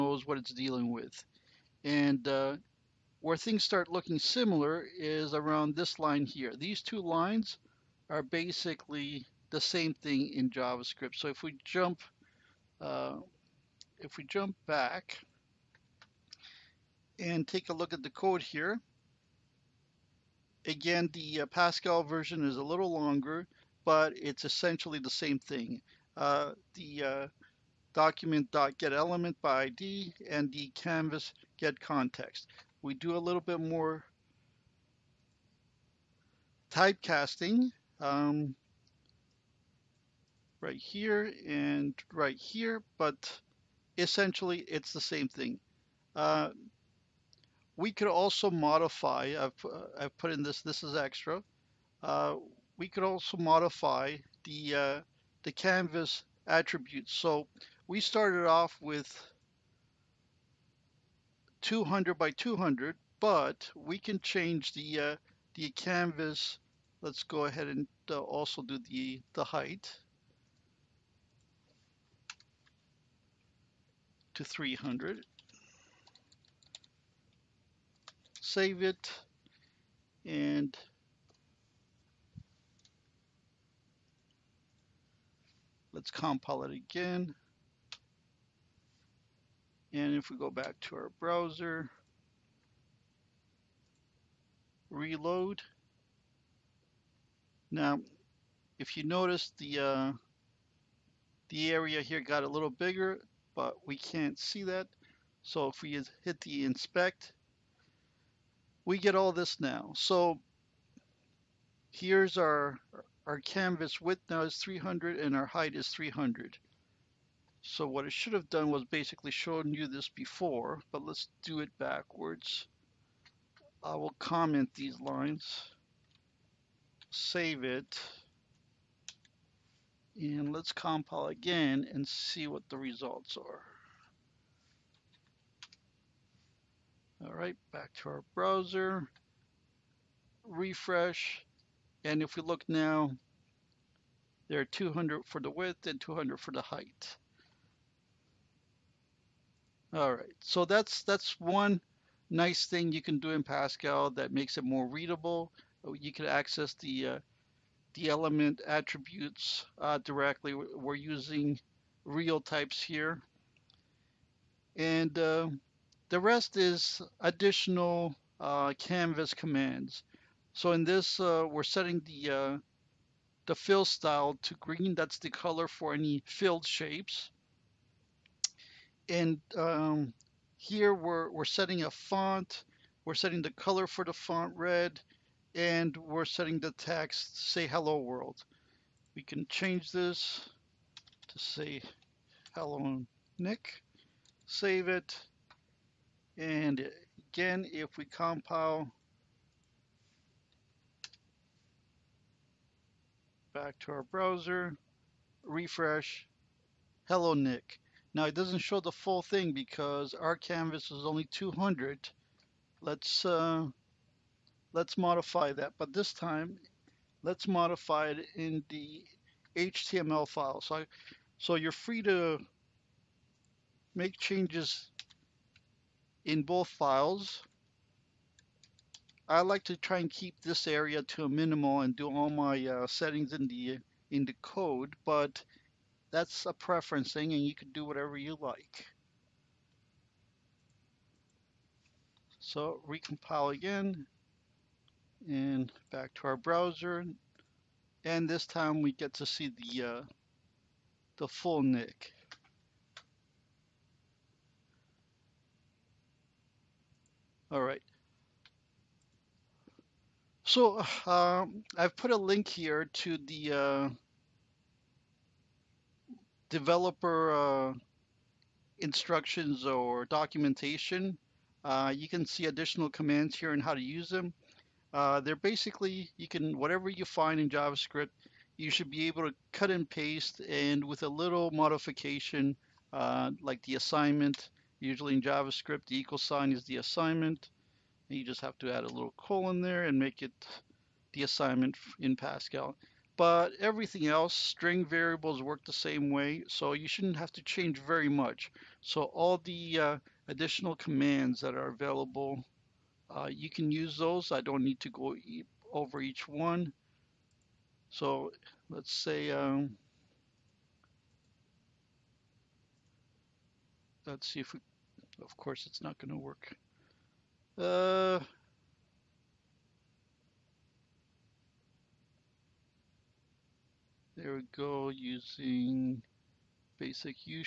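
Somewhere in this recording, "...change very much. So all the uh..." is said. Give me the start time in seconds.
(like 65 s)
297 s.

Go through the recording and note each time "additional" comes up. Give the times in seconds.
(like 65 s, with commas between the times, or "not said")
167 s, 272 s, 300 s.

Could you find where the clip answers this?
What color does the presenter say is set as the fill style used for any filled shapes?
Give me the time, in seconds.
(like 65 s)
174 s.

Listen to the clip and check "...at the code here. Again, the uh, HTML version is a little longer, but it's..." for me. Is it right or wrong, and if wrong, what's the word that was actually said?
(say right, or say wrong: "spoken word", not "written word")
wrong: "Pascal", not "HTML".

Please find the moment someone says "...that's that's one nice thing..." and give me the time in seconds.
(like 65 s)
150 s.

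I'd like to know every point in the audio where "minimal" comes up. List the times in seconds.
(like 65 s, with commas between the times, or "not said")
231 s.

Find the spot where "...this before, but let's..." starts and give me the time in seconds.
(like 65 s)
119 s.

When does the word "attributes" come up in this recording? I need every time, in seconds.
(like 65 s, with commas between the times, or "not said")
56 s, 158 s.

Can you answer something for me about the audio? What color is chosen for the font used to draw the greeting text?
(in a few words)
red.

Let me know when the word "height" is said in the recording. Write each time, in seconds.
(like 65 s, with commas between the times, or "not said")
69 s, 115 s, 146 s.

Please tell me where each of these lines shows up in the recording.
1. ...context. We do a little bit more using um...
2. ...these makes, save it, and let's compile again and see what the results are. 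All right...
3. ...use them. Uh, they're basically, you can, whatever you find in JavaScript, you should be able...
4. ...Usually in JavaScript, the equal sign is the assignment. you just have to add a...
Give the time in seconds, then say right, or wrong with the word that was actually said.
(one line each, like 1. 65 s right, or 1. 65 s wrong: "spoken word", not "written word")
1. 31 s wrong: "typecasting", not "using"
2. 124 s wrong: "lines", not "makes"
3. 273 s right
4. 284 s right.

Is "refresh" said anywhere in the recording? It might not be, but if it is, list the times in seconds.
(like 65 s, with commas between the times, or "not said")
140 s, 205 s.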